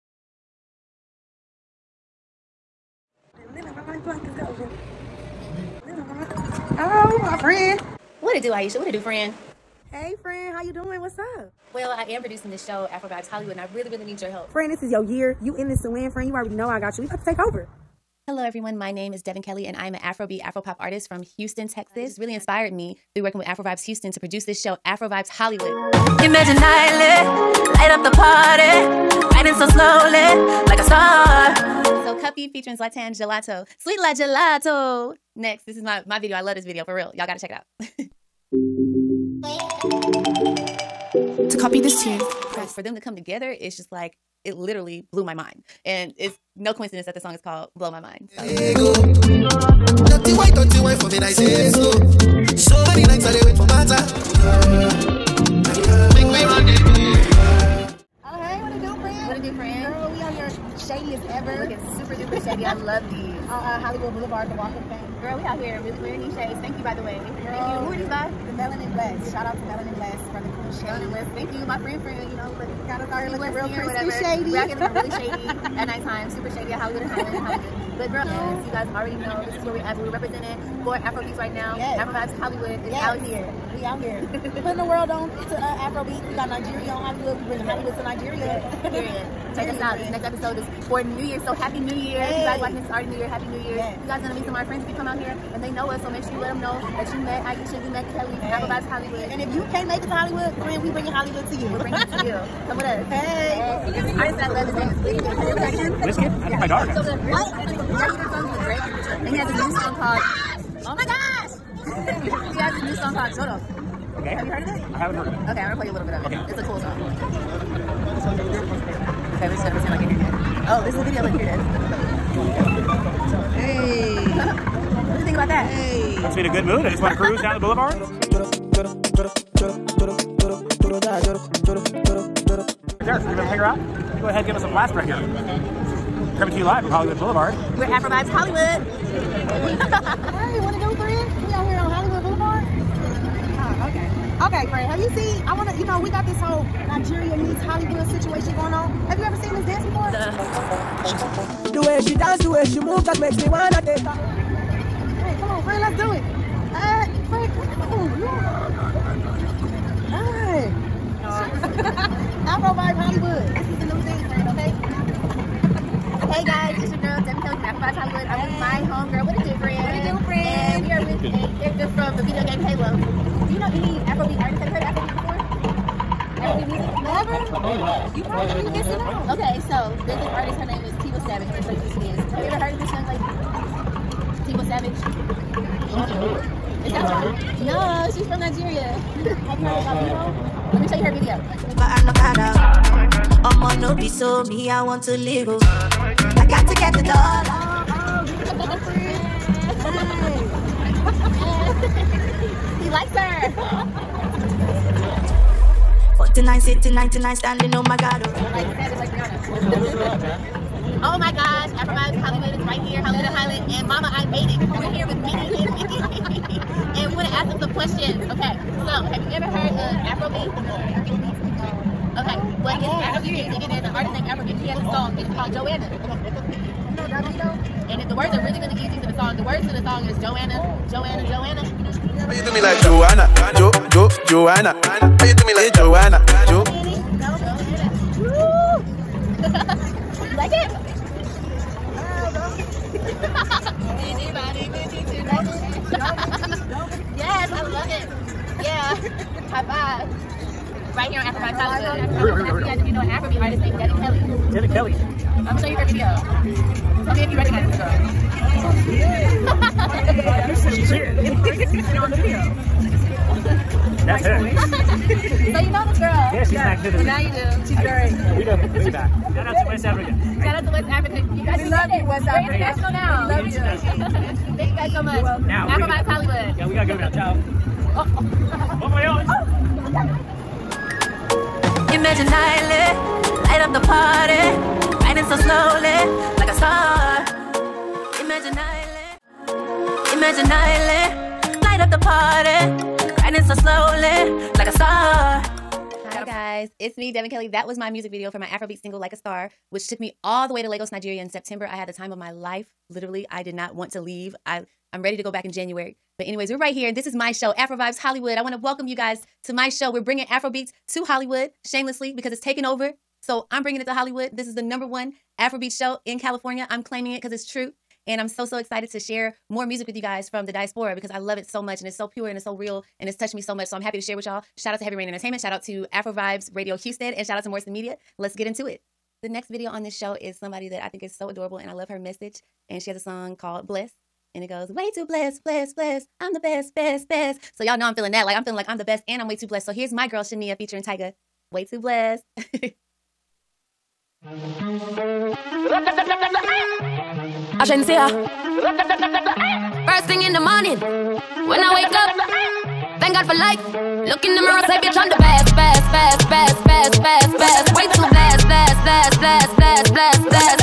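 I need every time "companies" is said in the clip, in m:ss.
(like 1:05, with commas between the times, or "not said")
not said.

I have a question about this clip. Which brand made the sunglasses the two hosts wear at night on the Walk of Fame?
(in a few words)
The Melanin Blast.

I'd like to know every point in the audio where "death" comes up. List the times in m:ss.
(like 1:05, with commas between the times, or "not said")
not said.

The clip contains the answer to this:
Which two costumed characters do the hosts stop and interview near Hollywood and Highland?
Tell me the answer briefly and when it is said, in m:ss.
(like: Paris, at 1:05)
Minnie and Mickey, at 3:35.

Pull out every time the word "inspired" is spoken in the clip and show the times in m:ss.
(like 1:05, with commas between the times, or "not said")
0:22.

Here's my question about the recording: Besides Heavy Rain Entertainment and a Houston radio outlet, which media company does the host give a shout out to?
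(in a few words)
Morrison Media.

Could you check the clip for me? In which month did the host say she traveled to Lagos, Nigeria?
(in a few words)
September.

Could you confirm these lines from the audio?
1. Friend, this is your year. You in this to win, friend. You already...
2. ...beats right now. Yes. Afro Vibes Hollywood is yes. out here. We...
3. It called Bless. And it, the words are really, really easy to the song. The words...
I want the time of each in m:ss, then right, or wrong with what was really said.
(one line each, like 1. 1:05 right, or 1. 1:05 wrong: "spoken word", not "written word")
1. 0:14 right
2. 1:21 right
3. 3:45 wrong: "Joanna", not "Bless".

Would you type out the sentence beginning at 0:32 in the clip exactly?
So Cuppy featuring Zlatan Gelato, Sweet La Gelato.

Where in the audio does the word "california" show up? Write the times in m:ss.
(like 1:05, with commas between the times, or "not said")
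5:16.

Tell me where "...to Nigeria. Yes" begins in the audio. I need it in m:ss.
1:27.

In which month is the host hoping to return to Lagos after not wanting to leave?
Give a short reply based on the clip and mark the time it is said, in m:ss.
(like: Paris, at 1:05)
January, at 5:05.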